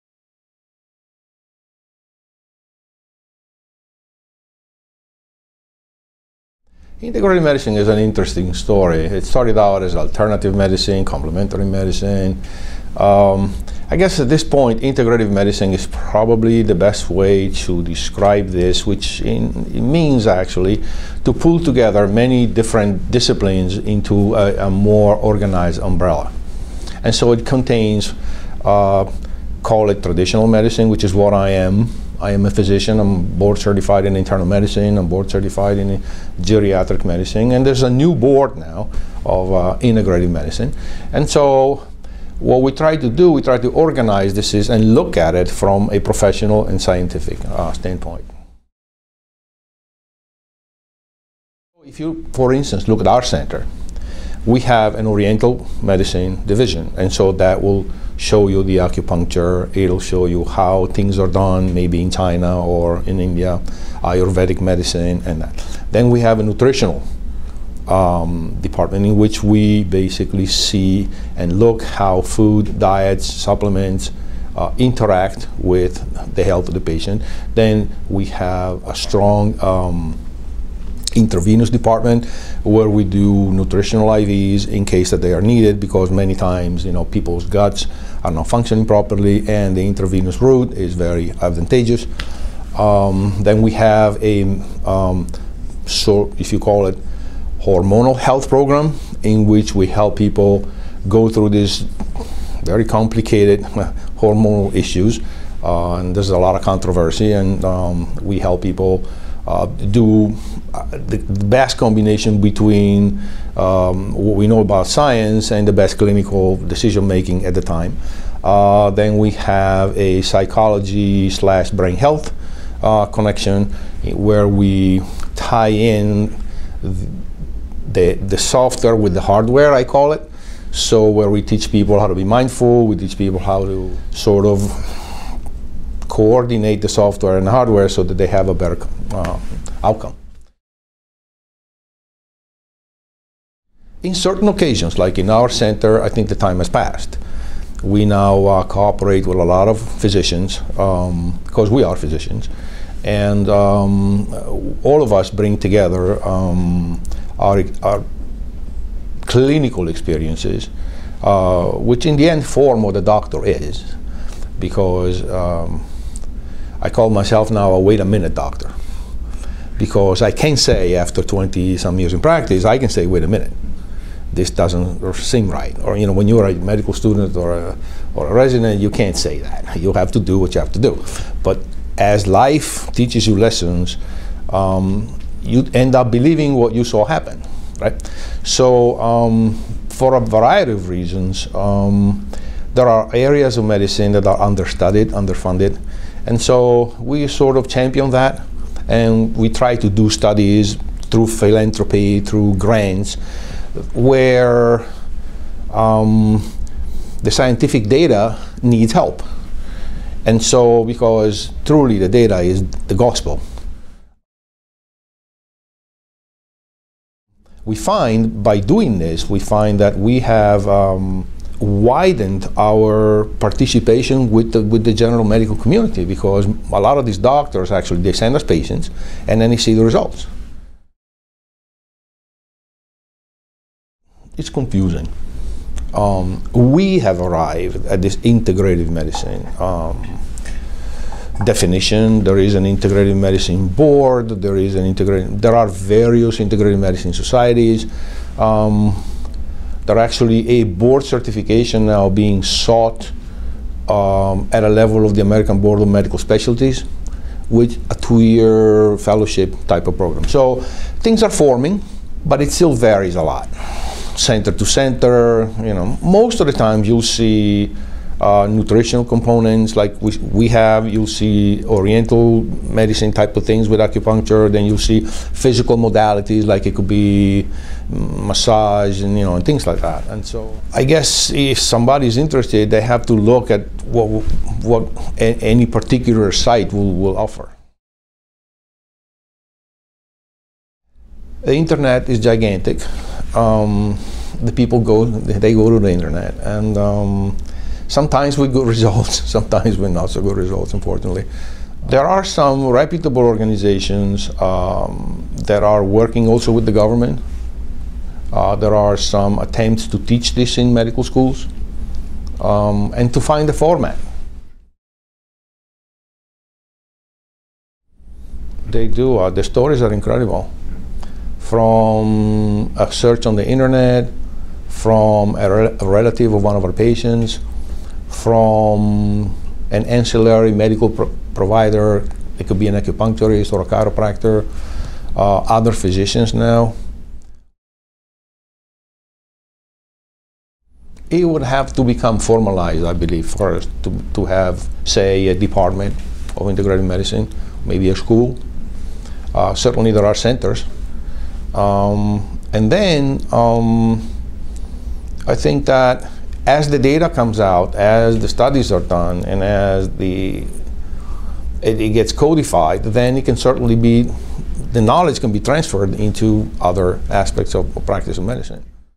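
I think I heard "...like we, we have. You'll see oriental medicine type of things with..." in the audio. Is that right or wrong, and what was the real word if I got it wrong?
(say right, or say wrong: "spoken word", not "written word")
right.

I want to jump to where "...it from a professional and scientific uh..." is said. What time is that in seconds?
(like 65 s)
45 s.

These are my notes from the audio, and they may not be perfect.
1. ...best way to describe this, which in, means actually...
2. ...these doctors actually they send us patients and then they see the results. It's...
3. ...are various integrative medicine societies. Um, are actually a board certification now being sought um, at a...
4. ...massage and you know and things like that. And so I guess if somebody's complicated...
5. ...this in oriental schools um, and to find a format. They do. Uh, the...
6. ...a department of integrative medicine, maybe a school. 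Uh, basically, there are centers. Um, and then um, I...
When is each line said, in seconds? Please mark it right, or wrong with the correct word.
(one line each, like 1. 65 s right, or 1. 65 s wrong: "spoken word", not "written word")
1. 16 s right
2. 227 s right
3. 245 s right
4. 277 s wrong: "interested", not "complicated"
5. 310 s wrong: "medical", not "oriental"
6. 345 s wrong: "certainly", not "basically".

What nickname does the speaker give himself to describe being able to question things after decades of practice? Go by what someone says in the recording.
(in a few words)
Wait a minute doctor.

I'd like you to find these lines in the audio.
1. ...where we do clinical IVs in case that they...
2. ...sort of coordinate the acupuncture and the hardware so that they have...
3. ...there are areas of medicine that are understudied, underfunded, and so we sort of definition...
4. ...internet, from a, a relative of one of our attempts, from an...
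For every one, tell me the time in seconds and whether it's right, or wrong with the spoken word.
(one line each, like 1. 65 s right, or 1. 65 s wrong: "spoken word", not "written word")
1. 82 s wrong: "nutritional", not "clinical"
2. 134 s wrong: "software", not "acupuncture"
3. 192 s wrong: "champion", not "definition"
4. 323 s wrong: "patients", not "attempts".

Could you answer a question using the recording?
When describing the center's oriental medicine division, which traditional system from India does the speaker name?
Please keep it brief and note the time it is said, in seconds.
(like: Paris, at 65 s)
Ayurvedic medicine, at 64 s.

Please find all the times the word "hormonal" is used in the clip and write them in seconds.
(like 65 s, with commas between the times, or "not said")
97 s, 104 s.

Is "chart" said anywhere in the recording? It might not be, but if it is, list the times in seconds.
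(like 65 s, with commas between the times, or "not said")
not said.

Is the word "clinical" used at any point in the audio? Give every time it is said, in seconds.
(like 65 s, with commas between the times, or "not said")
115 s, 159 s.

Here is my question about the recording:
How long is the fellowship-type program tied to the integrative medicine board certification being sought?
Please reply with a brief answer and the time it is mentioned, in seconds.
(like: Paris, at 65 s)
2 years, at 257 s.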